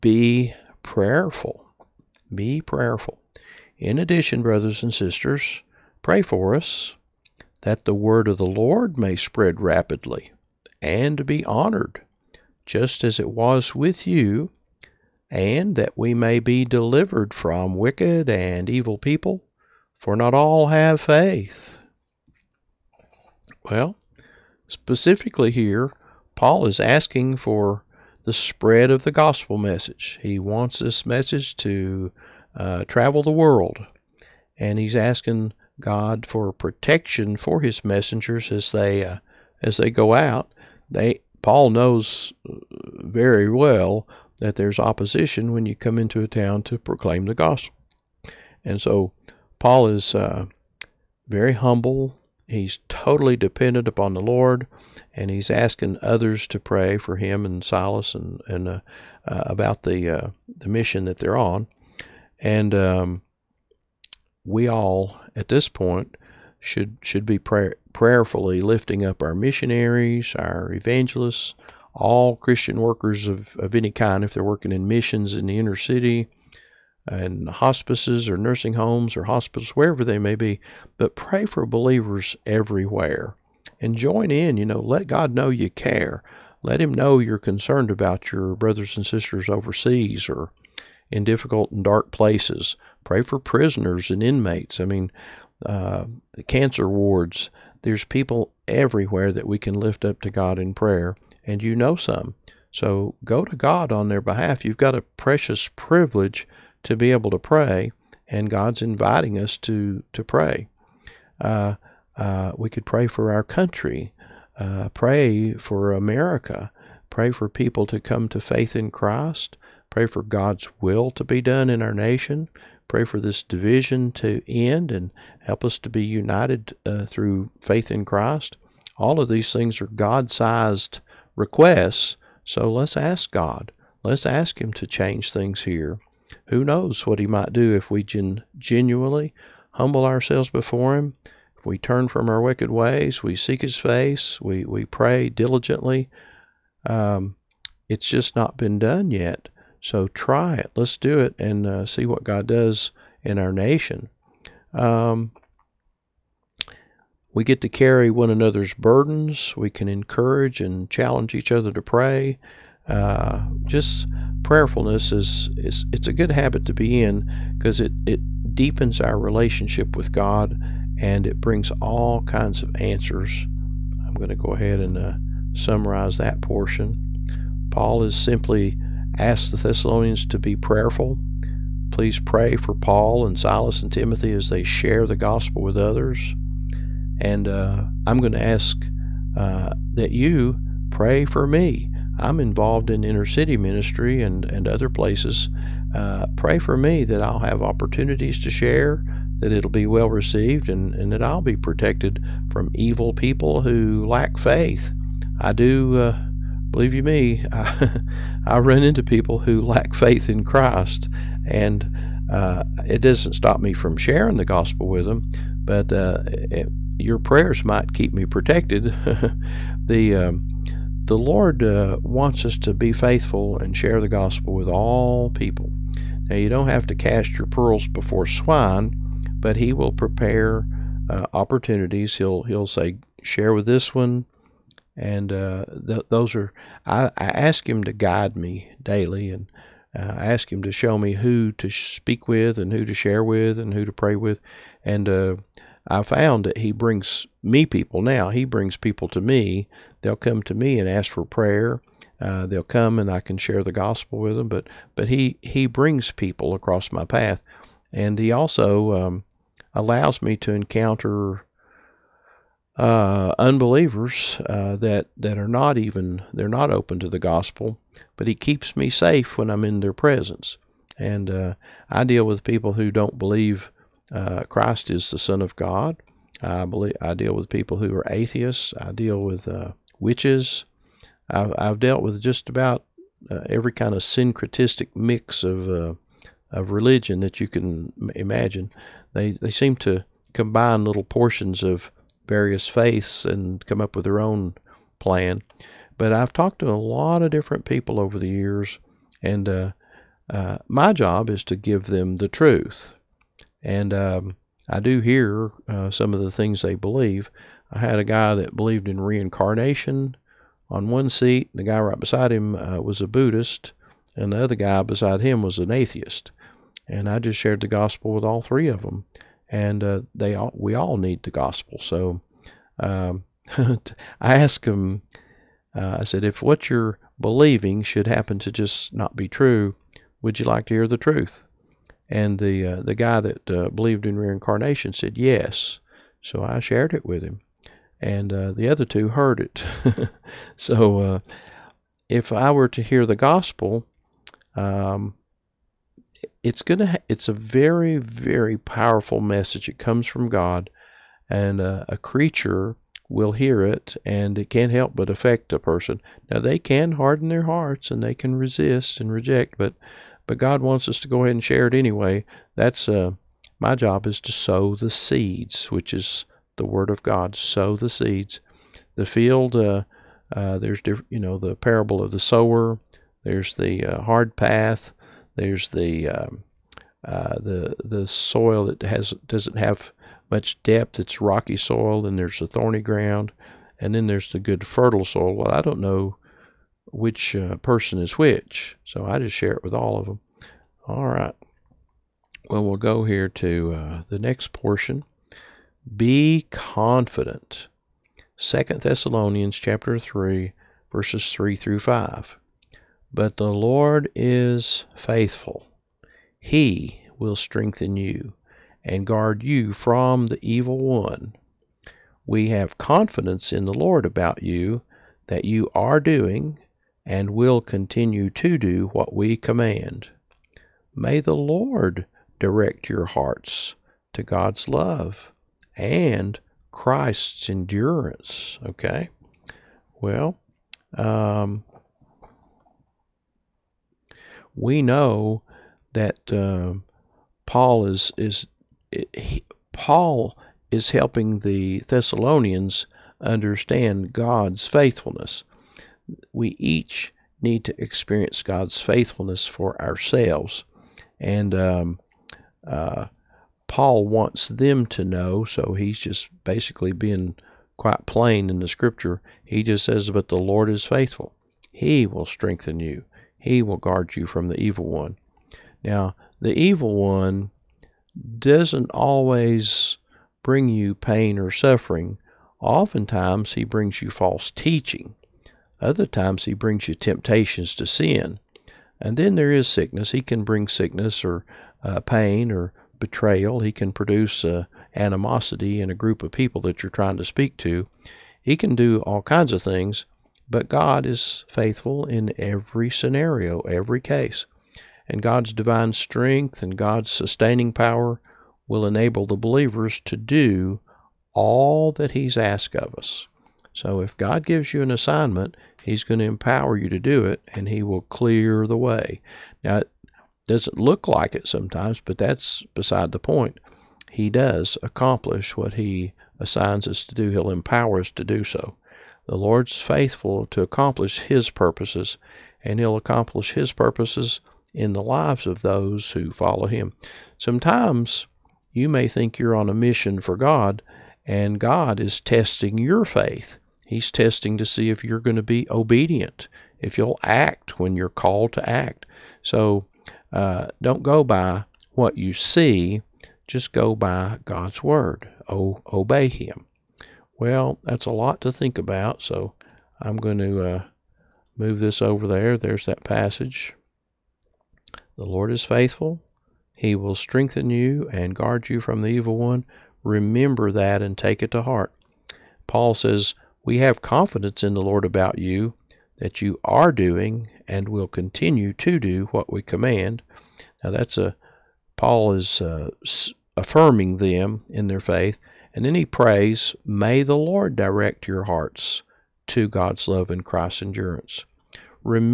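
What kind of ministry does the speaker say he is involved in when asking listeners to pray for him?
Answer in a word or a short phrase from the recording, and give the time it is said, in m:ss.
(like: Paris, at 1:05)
Inner city ministry, at 3:13.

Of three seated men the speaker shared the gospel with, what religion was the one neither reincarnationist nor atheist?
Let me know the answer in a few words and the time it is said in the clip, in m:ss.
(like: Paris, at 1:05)
Buddhist, at 5:13.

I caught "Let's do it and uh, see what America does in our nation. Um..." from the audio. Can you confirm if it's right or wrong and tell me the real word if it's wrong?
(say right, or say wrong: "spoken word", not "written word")
wrong: "God", not "America".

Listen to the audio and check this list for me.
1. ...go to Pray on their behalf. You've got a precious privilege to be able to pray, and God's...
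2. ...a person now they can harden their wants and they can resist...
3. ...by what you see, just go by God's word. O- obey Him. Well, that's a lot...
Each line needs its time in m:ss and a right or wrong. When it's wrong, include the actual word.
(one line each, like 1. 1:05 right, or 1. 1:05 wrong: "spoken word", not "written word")
1. 1:43 wrong: "God", not "Pray"
2. 5:55 wrong: "hearts", not "wants"
3. 9:01 right.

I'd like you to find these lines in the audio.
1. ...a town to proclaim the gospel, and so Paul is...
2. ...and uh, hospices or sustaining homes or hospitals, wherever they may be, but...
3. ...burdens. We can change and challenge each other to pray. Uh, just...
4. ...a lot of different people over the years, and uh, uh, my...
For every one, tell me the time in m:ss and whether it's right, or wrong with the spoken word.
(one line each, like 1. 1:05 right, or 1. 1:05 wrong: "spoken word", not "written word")
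1. 0:46 right
2. 1:17 wrong: "nursing", not "sustaining"
3. 2:38 wrong: "encourage", not "change"
4. 4:56 right.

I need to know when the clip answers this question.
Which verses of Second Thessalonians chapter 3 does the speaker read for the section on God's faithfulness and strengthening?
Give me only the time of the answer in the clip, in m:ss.
6:40.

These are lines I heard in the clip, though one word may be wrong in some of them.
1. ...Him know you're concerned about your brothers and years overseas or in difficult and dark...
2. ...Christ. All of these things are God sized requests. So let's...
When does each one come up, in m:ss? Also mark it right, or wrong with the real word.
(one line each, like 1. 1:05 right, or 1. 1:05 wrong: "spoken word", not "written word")
1. 1:26 wrong: "sisters", not "years"
2. 2:08 right.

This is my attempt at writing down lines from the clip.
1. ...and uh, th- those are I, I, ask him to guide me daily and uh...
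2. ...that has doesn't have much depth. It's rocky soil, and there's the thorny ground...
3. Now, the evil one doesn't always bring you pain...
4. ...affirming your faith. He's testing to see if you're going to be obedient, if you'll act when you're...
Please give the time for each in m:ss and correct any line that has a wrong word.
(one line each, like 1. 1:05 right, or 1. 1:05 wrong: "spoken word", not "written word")
1. 3:54 right
2. 6:18 right
3. 7:45 right
4. 8:52 wrong: "testing", not "affirming".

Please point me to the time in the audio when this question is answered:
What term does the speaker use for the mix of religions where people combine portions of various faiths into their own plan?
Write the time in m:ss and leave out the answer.
4:44.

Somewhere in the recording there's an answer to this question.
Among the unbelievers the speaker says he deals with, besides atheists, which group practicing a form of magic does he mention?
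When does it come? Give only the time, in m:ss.
4:39.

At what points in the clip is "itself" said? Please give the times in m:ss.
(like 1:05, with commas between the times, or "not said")
not said.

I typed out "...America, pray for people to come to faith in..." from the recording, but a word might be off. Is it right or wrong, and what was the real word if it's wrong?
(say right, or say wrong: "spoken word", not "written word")
right.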